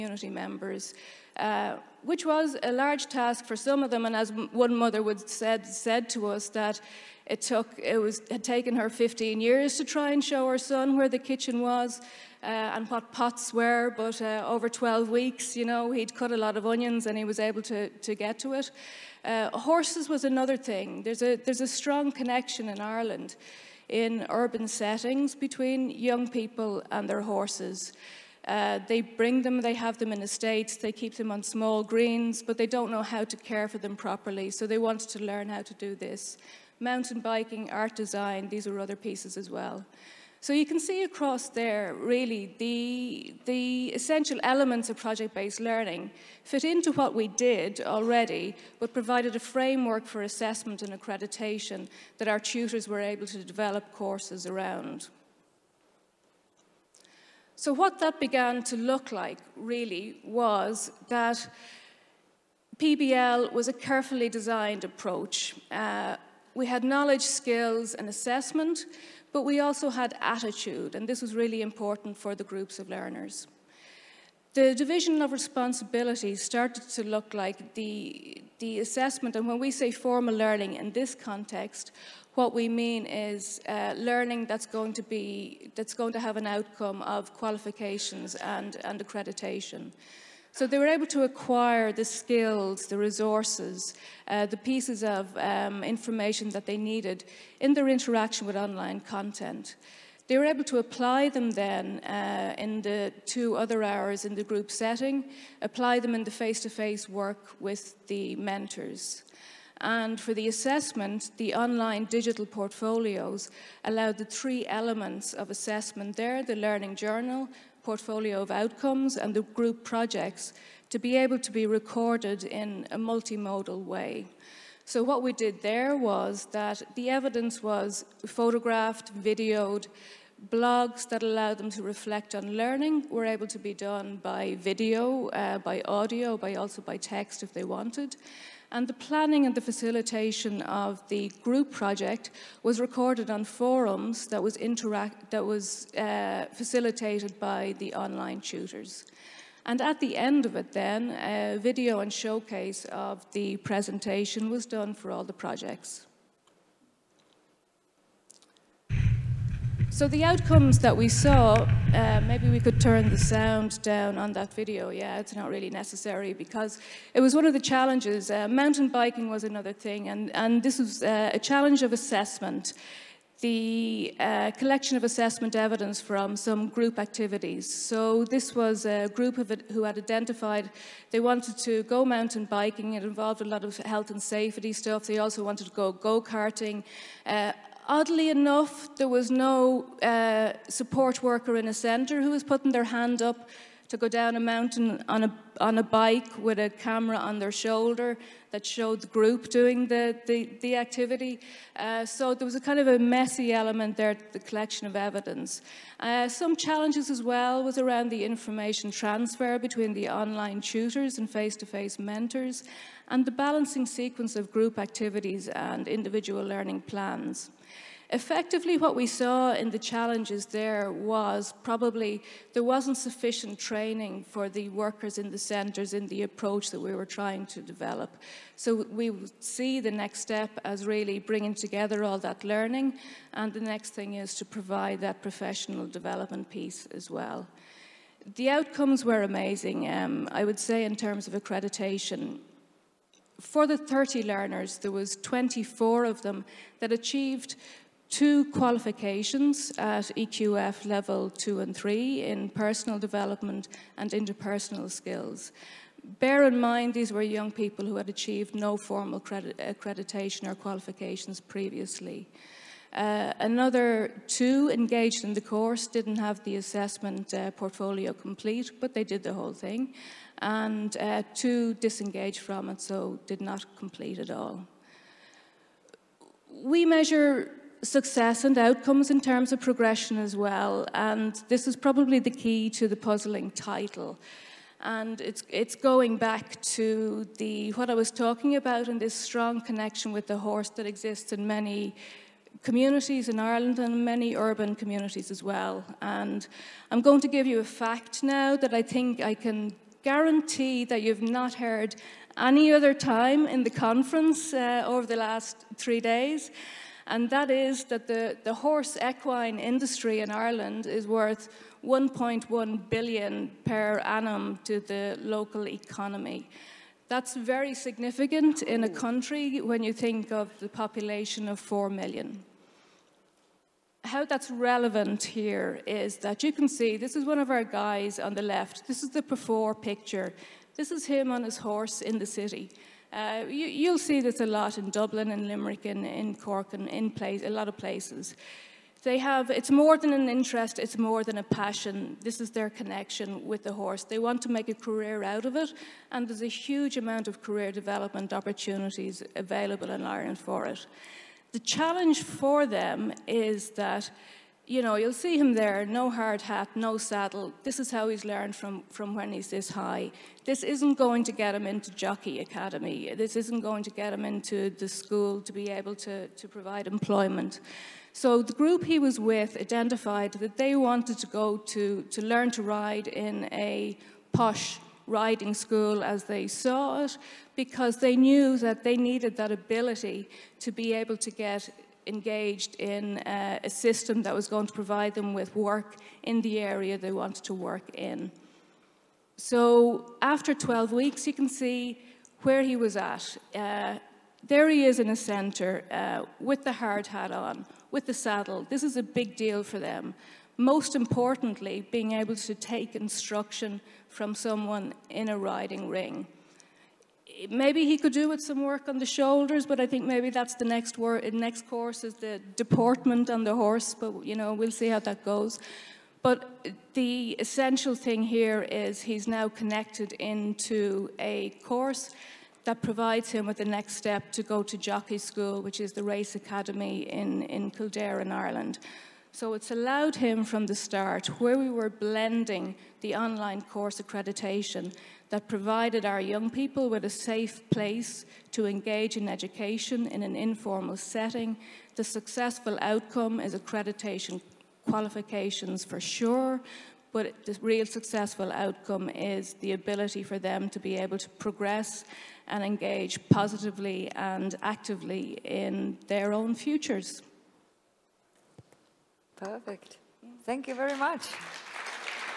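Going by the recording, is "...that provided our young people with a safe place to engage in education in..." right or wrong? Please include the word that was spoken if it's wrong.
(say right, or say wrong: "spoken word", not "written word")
right.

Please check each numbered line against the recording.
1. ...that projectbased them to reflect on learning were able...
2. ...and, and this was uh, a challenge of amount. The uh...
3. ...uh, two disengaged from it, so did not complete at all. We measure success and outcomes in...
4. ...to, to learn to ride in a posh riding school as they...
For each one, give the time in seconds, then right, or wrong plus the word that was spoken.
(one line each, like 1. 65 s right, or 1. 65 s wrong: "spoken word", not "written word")
1. 131 s wrong: "allowed", not "projectbased"
2. 170 s wrong: "assessment", not "amount"
3. 270 s right
4. 371 s right.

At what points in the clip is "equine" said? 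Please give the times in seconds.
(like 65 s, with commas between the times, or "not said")
309 s.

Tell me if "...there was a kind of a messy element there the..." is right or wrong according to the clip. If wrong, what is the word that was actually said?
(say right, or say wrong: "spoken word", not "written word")
right.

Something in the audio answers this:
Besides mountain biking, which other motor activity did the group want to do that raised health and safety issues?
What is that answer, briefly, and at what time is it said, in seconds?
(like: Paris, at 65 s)
Go-karting, at 185 s.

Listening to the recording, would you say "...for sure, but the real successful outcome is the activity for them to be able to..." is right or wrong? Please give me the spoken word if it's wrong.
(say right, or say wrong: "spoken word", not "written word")
wrong: "ability", not "activity".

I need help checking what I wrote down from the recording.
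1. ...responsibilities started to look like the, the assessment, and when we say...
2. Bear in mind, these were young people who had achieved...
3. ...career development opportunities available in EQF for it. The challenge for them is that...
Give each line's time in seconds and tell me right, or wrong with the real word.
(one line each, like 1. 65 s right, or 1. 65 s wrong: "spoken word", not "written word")
1. 75 s right
2. 256 s right
3. 347 s wrong: "Ireland", not "EQF".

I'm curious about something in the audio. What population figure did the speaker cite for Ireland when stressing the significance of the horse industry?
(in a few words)
4 million.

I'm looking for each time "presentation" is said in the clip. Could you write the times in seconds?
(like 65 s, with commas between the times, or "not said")
153 s.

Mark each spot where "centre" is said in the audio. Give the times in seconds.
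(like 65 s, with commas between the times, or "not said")
191 s, 225 s, 395 s.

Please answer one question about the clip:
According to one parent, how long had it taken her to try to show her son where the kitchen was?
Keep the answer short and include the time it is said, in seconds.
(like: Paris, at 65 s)
15 years, at 8 s.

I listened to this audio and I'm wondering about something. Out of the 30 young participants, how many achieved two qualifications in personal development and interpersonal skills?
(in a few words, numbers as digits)
24.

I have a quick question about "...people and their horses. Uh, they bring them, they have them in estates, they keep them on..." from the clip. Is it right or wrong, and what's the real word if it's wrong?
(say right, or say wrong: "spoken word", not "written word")
right.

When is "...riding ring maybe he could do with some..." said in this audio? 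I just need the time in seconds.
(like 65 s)
405 s.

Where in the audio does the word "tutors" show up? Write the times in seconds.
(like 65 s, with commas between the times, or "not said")
52 s, 148 s, 210 s.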